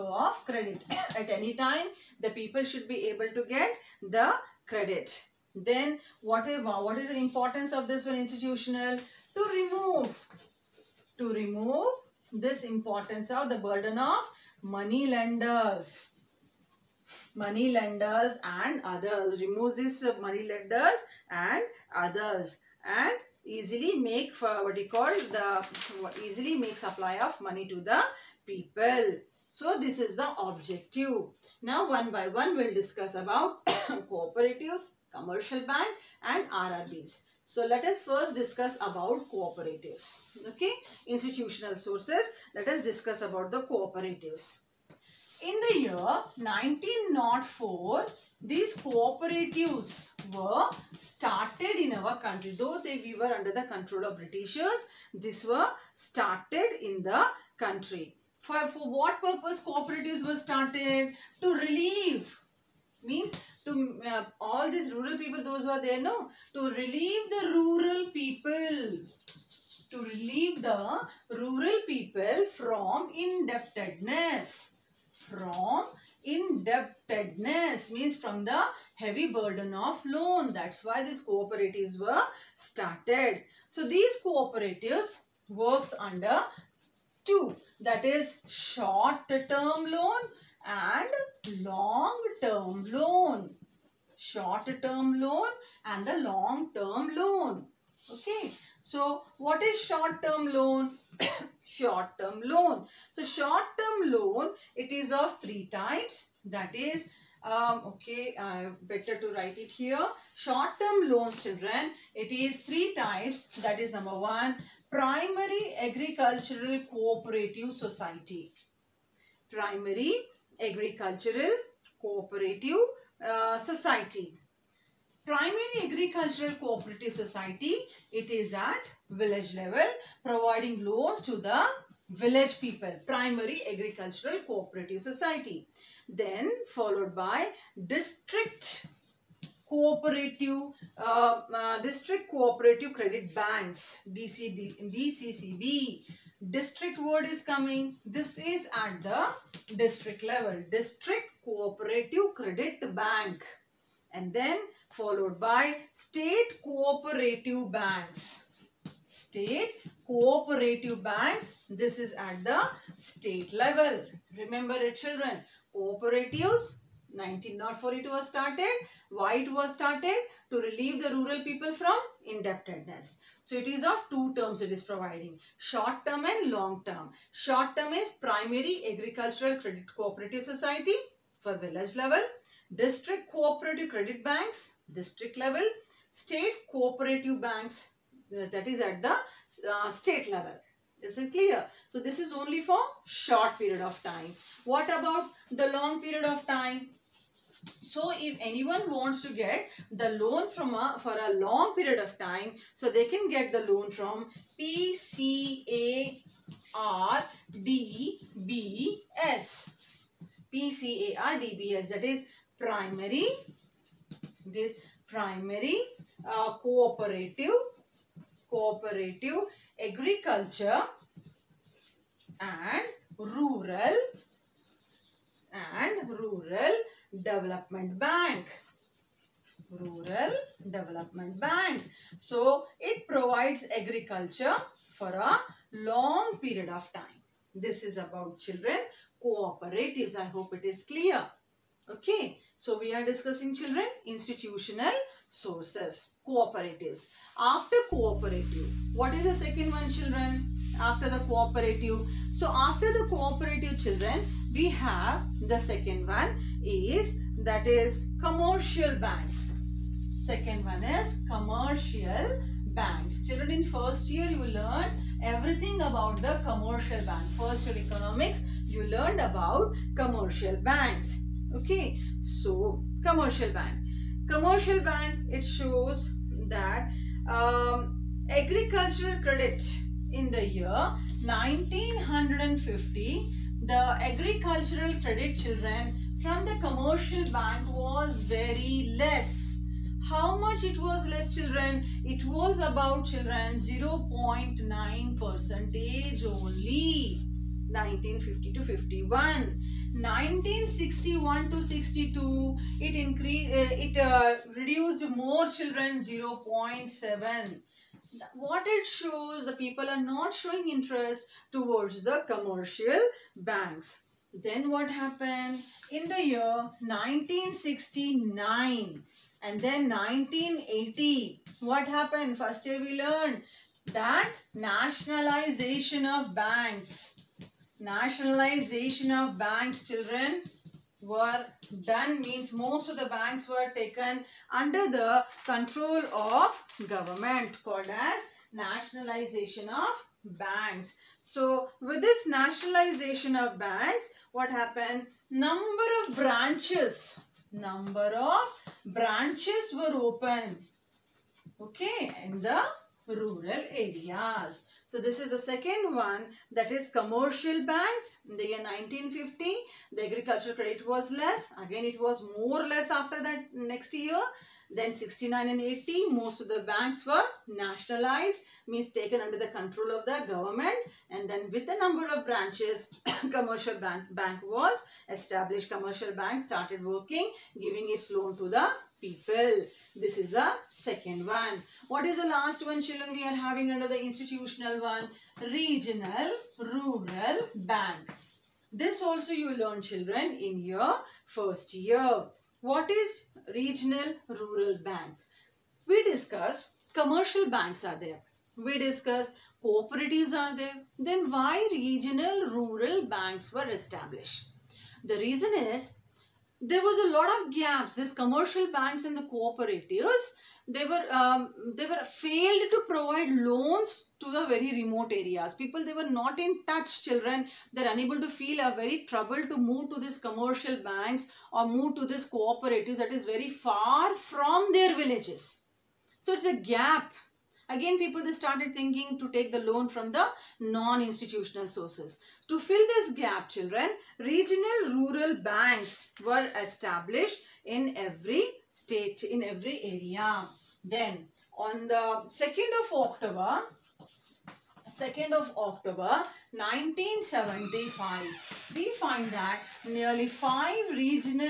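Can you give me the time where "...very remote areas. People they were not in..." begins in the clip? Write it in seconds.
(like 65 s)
414 s.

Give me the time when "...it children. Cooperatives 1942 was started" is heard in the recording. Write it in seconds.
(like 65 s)
164 s.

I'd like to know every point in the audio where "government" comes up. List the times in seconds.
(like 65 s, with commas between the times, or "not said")
336 s, 370 s.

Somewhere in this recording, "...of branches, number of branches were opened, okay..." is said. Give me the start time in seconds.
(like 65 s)
346 s.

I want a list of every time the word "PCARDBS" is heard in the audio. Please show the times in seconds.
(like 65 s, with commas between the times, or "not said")
204 s, 210 s.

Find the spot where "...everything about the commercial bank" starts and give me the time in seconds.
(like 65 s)
265 s.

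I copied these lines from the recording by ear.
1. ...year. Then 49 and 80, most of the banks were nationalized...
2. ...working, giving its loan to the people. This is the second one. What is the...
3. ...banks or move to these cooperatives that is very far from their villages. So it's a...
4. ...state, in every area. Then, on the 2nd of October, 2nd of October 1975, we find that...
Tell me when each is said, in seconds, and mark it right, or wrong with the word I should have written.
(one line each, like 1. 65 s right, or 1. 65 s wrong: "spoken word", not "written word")
1. 363 s wrong: "69", not "49"
2. 376 s right
3. 420 s right
4. 438 s right.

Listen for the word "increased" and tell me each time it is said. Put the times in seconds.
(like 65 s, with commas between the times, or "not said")
302 s.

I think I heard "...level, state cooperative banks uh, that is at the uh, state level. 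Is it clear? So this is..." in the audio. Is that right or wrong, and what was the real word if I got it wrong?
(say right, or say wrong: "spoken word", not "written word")
right.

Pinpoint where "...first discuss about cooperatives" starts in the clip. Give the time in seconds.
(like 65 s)
38 s.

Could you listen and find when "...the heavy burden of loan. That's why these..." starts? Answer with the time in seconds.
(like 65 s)
78 s.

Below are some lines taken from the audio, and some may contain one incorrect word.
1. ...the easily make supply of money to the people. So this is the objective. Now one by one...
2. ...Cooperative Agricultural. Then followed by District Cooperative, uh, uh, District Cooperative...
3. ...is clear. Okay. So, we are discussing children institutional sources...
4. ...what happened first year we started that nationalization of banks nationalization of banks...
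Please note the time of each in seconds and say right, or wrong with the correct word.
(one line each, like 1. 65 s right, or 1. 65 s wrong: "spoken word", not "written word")
1. 25 s right
2. 134 s wrong: "Society", not "Agricultural"
3. 240 s right
4. 321 s wrong: "learned", not "started".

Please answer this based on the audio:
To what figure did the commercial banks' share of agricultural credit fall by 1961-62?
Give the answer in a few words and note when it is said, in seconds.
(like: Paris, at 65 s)
0.7%, at 306 s.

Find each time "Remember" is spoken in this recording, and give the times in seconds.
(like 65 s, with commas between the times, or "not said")
164 s.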